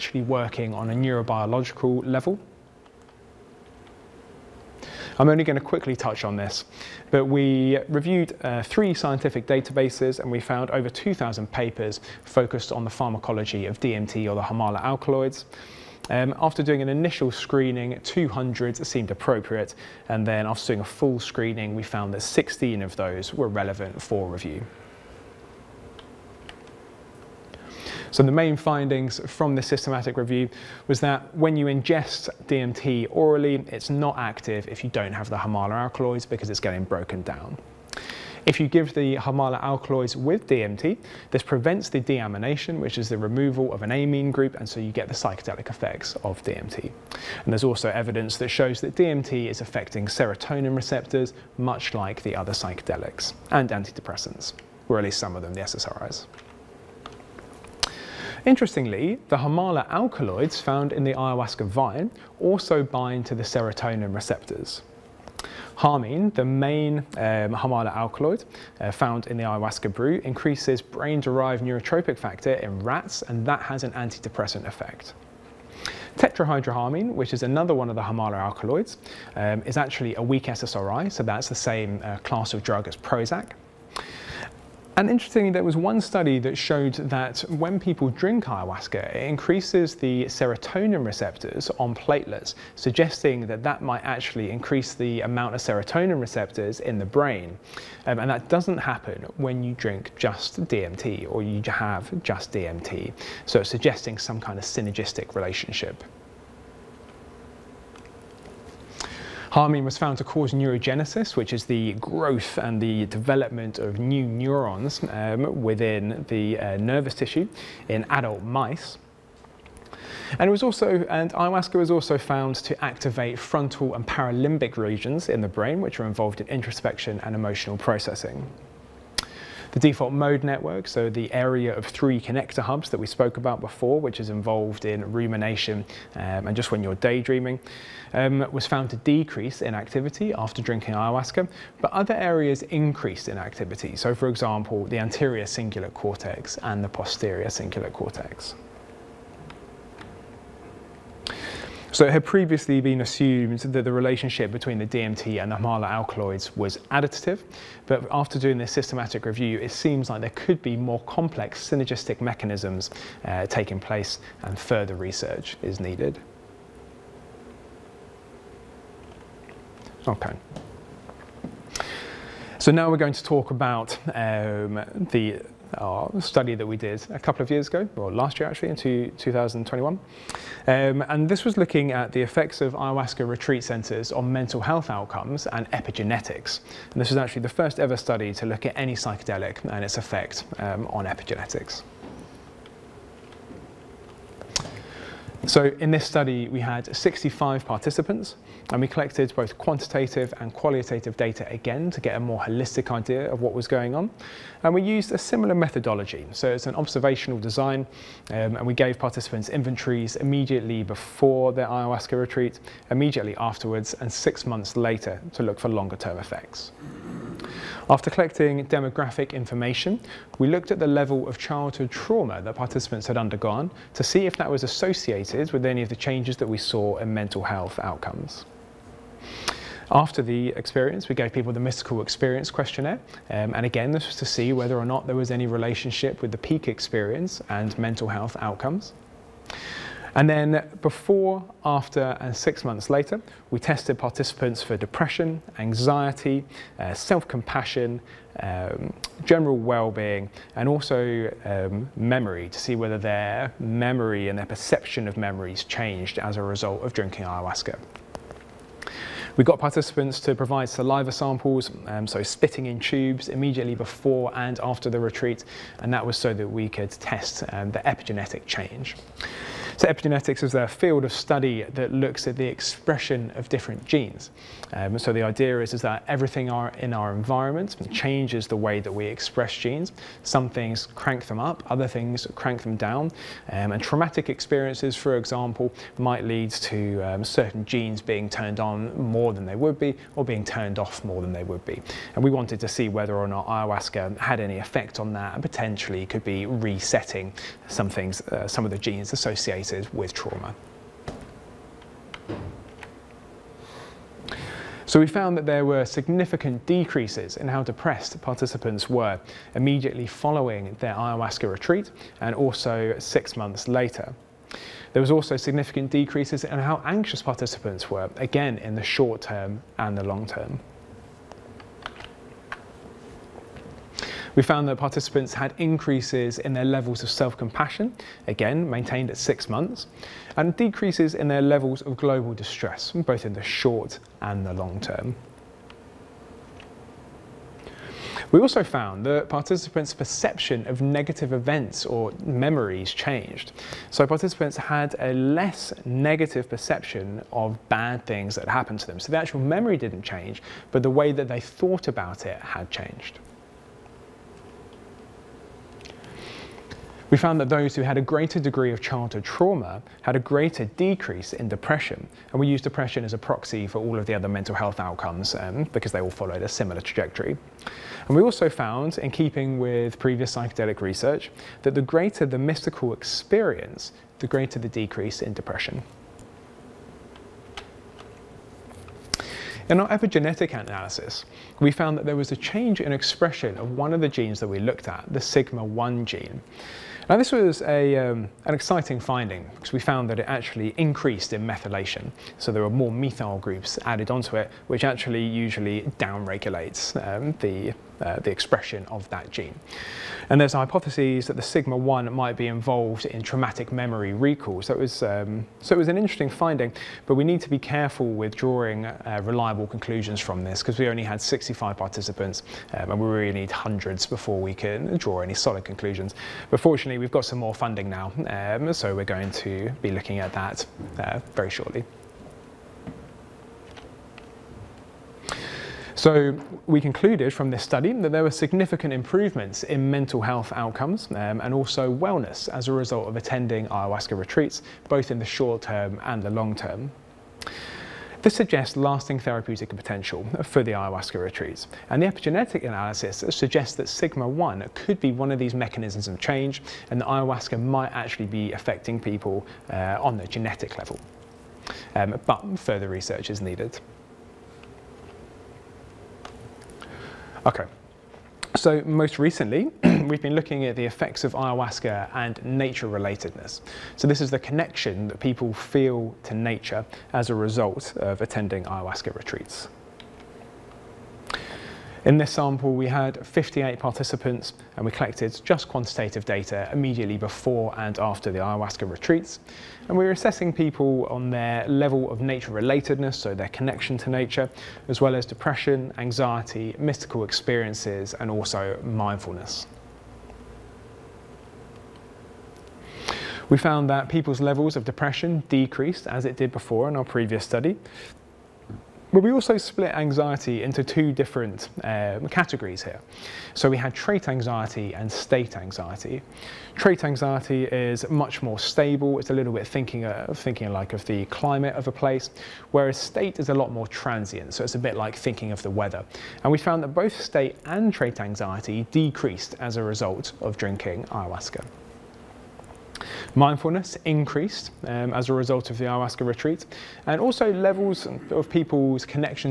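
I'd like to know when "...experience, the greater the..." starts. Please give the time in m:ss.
6:12.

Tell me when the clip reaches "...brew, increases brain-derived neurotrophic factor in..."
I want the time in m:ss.
1:09.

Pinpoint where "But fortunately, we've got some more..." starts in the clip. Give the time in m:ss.
6:56.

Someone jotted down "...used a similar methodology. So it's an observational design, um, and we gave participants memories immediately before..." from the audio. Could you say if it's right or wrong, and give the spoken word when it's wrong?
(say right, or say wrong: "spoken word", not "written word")
wrong: "inventories", not "memories".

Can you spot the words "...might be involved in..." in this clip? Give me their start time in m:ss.
6:42.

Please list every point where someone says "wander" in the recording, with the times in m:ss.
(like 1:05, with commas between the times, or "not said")
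not said.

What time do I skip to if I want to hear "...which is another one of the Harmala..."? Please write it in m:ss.
1:17.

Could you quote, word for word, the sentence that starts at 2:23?
So for example, the anterior cingulate cortex and the posterior cingulate cortex.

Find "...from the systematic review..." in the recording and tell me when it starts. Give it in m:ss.
0:29.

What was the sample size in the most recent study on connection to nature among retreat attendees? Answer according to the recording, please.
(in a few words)
58.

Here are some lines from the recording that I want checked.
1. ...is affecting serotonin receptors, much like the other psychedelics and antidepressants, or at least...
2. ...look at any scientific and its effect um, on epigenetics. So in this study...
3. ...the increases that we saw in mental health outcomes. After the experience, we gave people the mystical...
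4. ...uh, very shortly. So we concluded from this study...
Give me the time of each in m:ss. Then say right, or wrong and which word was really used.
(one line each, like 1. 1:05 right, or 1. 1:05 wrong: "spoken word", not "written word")
1. 0:49 right
2. 3:08 wrong: "psychedelic", not "scientific"
3. 3:45 wrong: "changes", not "increases"
4. 7:00 right.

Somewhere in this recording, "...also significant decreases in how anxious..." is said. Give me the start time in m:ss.
5:15.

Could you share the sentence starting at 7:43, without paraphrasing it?
So this is the connection that people feel to nature as a result of attending ayahuasca retreats.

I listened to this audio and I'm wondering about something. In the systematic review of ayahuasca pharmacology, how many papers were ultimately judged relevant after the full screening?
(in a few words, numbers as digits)
16.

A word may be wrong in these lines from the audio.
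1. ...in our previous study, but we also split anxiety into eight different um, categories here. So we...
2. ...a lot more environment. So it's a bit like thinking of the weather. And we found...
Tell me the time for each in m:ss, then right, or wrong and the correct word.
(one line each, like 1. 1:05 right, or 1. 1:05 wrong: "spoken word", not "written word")
1. 8:16 wrong: "two", not "eight"
2. 8:33 wrong: "transient", not "environment".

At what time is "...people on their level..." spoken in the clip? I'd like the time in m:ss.
8:00.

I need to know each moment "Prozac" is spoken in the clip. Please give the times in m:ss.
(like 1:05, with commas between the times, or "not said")
1:22.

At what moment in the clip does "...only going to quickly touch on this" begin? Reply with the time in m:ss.
0:05.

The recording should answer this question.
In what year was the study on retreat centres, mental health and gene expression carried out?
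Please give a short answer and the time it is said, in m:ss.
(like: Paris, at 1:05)
2021, at 2:59.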